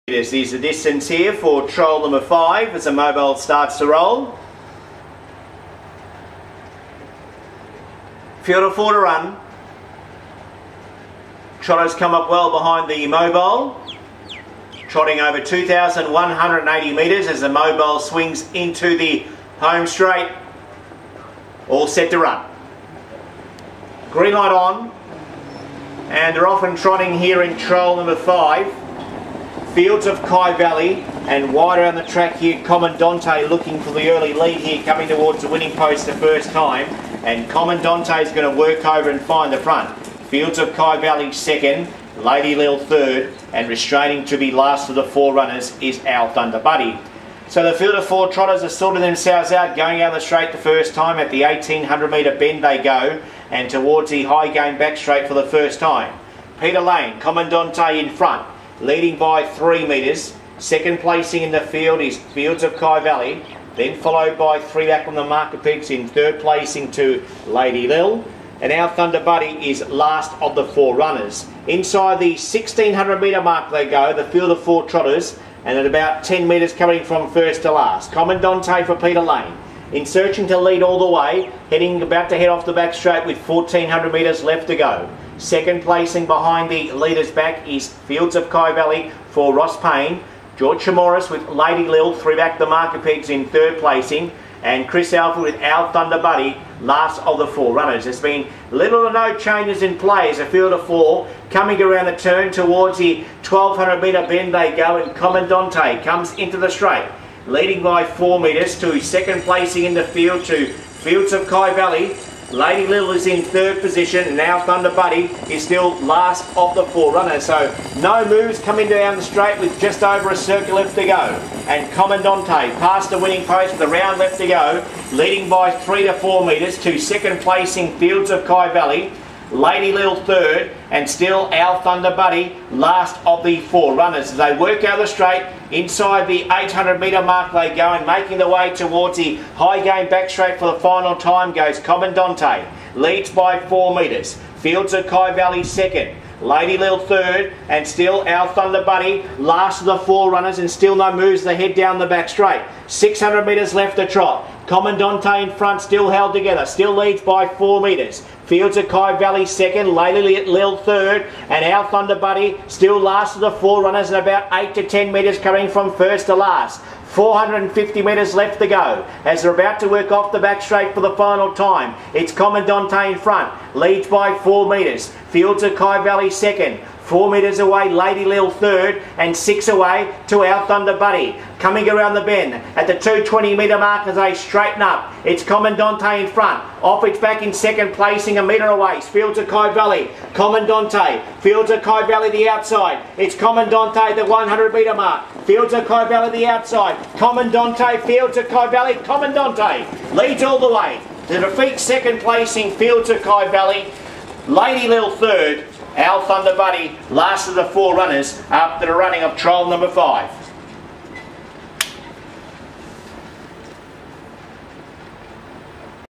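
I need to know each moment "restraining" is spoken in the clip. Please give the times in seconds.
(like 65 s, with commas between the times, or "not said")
43 s.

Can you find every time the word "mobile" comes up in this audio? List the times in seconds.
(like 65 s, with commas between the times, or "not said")
2 s, 13 s, 17 s.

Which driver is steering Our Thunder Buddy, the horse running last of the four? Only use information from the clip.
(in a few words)
Chris Alford.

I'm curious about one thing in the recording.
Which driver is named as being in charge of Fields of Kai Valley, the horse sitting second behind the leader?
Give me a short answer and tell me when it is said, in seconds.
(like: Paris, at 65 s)
Ross Payne, at 89 s.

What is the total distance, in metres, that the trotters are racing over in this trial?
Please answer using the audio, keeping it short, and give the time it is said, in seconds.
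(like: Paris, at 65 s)
2,180 metres, at 15 s.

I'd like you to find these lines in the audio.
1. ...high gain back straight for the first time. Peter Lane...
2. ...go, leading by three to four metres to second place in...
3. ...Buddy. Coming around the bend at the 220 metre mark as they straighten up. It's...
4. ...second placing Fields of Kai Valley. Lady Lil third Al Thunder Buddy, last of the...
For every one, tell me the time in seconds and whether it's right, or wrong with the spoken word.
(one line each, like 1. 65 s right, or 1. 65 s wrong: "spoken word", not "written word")
1. 54 s right
2. 124 s right
3. 180 s right
4. 201 s right.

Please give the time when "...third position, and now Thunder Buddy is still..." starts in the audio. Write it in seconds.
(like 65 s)
113 s.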